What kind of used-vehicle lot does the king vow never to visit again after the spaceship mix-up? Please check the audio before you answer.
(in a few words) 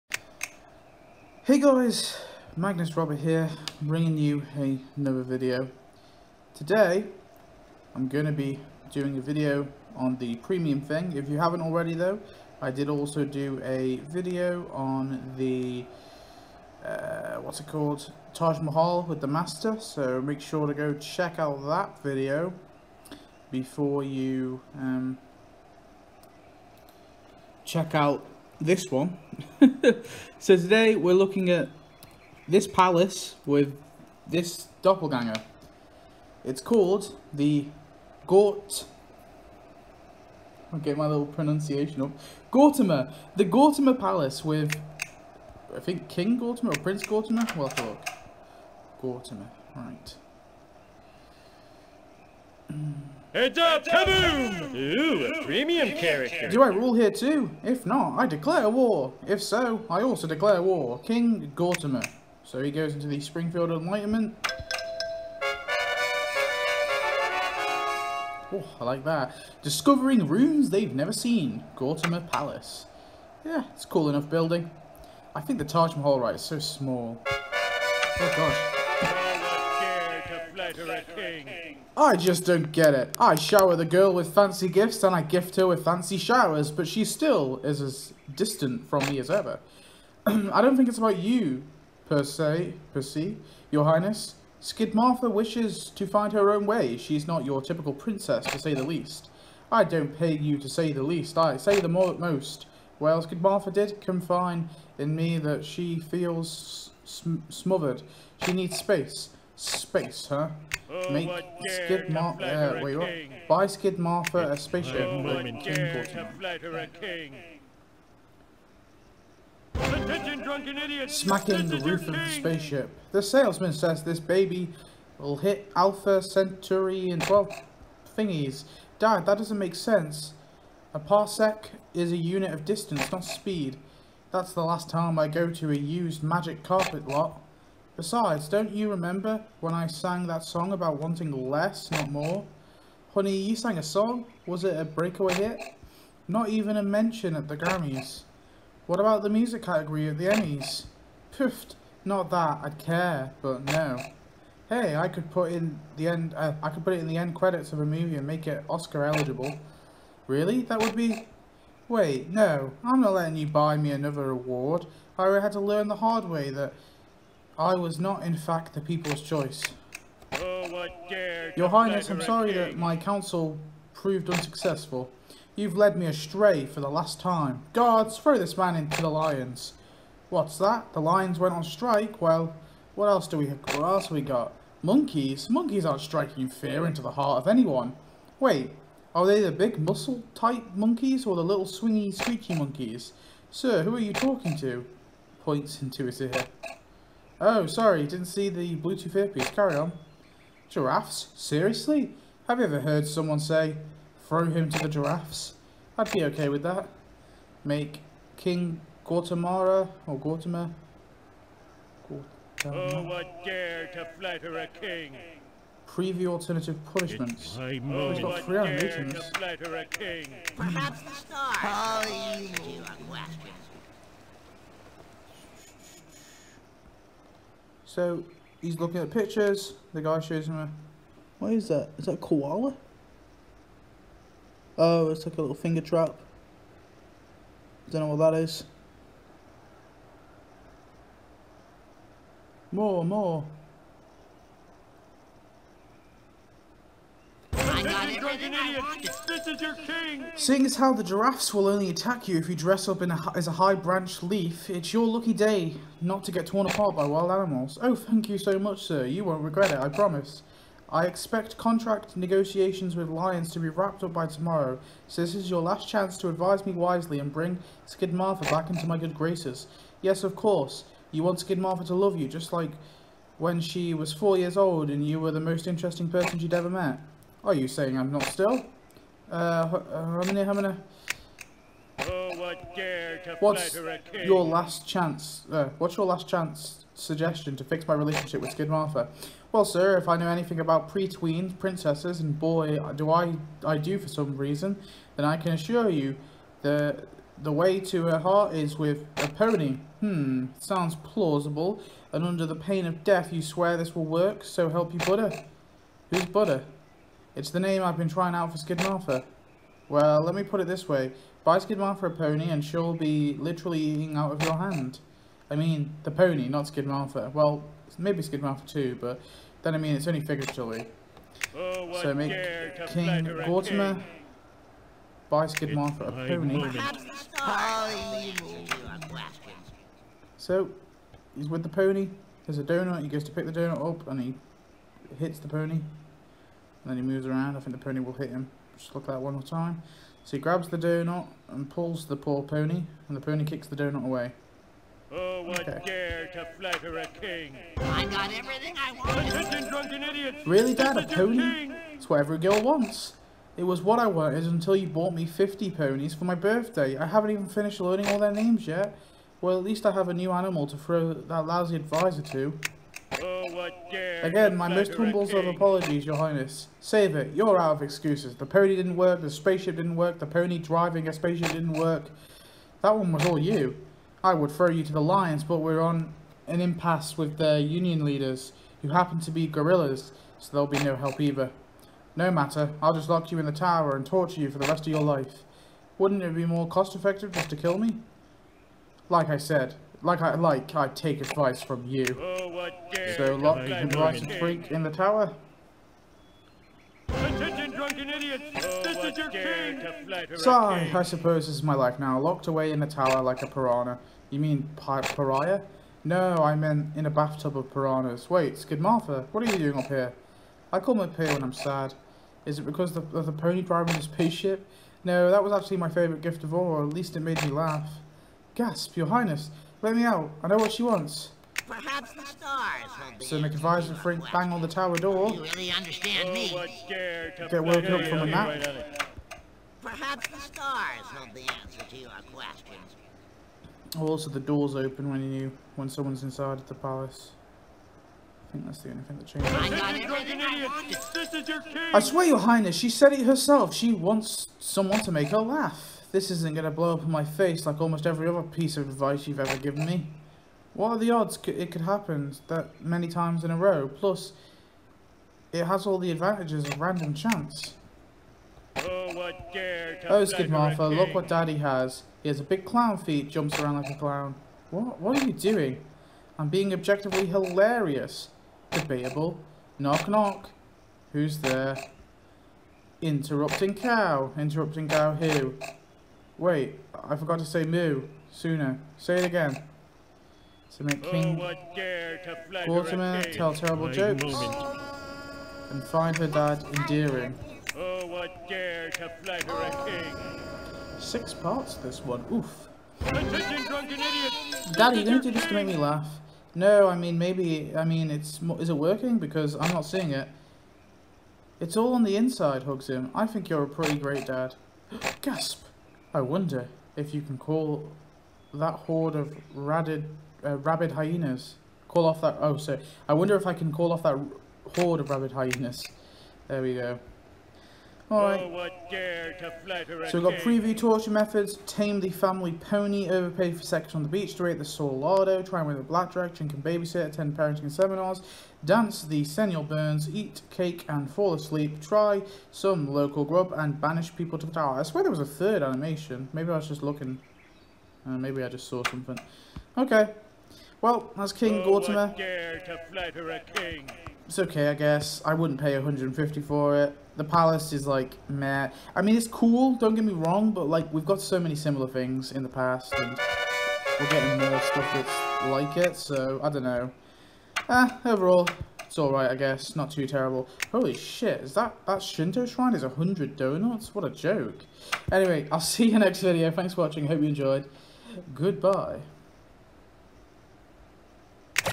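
Used magic carpet lot.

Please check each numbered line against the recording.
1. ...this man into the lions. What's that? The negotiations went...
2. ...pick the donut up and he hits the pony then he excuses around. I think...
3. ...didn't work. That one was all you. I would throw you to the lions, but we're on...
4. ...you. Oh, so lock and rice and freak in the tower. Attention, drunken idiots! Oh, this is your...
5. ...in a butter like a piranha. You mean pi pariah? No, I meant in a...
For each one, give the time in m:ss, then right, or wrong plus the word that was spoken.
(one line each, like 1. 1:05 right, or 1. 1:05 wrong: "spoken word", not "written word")
1. 2:58 wrong: "lions", not "negotiations"
2. 5:33 wrong: "moves", not "excuses"
3. 6:11 right
4. 6:31 right
5. 6:42 wrong: "tower", not "butter".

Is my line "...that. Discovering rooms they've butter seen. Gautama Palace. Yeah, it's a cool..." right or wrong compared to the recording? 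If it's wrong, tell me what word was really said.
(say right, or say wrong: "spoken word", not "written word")
wrong: "never", not "butter".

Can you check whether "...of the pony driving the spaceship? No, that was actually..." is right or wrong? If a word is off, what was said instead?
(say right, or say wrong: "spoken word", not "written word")
right.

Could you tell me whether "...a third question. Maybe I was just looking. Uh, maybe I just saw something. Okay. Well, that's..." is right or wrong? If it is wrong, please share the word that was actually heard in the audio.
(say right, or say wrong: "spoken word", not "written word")
wrong: "animation", not "question".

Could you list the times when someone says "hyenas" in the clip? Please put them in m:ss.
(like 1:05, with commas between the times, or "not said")
8:30, 8:35.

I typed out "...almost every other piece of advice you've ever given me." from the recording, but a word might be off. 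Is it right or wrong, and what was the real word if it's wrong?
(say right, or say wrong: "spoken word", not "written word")
right.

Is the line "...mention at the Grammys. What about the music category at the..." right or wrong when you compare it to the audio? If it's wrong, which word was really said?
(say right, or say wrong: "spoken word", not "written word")
right.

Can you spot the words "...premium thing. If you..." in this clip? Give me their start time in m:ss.
0:10.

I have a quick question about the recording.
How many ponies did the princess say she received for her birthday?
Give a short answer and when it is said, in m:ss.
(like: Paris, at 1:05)
50, at 5:55.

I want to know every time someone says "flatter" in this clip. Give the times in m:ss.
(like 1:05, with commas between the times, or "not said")
3:34, 5:46, 8:09.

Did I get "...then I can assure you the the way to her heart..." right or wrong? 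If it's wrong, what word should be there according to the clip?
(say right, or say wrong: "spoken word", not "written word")
right.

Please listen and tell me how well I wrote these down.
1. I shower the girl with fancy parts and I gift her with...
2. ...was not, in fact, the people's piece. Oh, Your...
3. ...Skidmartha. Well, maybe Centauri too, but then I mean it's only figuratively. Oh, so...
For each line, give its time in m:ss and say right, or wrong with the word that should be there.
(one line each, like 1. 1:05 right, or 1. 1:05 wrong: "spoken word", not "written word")
1. 1:23 wrong: "gifts", not "parts"
2. 2:47 wrong: "choice", not "piece"
3. 5:16 wrong: "Skidmartha", not "Centauri".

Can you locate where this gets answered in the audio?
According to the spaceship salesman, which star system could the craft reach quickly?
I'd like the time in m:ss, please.
2:05.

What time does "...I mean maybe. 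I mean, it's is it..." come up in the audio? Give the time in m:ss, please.
8:16.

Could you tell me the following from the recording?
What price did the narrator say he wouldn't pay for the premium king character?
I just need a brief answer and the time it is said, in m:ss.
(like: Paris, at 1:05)
150, at 9:05.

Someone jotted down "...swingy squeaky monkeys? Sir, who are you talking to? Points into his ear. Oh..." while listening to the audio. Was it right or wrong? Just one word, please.
right.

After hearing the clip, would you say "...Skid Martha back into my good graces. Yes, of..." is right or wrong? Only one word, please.
right.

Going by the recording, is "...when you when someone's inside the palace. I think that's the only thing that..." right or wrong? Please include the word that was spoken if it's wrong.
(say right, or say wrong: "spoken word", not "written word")
right.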